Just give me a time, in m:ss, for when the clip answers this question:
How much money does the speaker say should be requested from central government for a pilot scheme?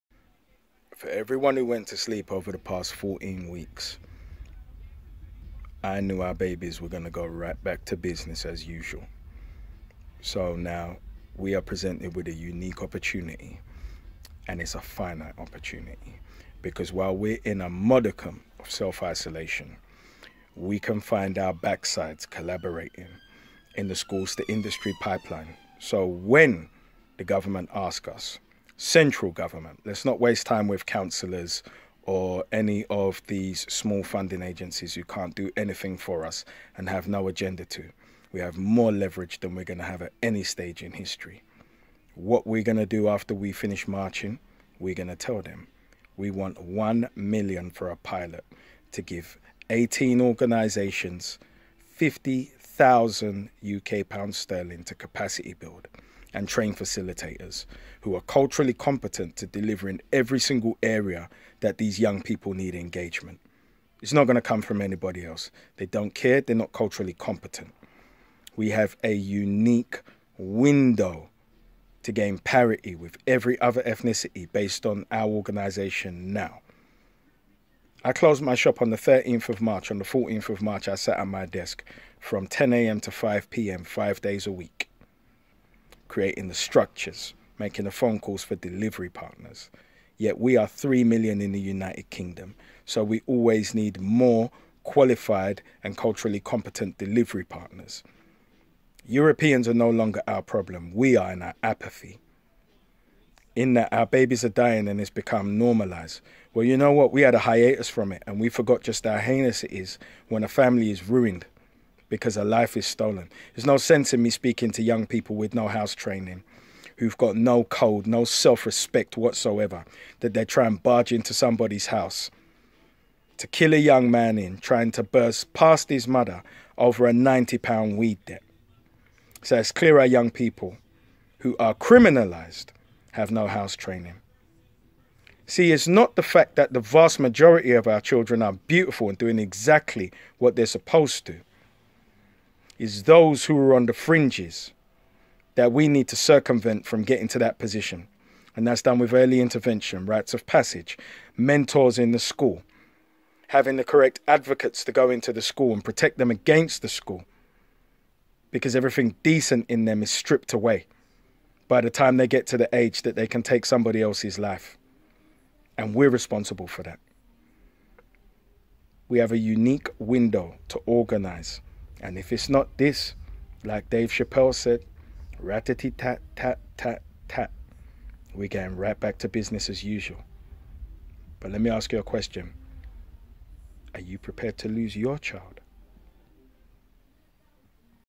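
0:46.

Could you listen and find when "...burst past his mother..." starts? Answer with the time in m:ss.
2:05.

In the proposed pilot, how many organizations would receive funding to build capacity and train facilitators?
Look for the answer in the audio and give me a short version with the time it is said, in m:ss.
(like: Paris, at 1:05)
18, at 0:49.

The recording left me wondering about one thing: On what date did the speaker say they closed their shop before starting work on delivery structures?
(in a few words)
13th of March.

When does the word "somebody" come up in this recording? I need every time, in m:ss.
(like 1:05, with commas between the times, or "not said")
2:01, 2:43.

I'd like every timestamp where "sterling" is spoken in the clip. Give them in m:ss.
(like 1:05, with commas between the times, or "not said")
0:54.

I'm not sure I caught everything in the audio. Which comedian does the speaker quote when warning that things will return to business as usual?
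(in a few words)
Dave Chappelle.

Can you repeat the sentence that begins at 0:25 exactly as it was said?
So when the government asks us, central government.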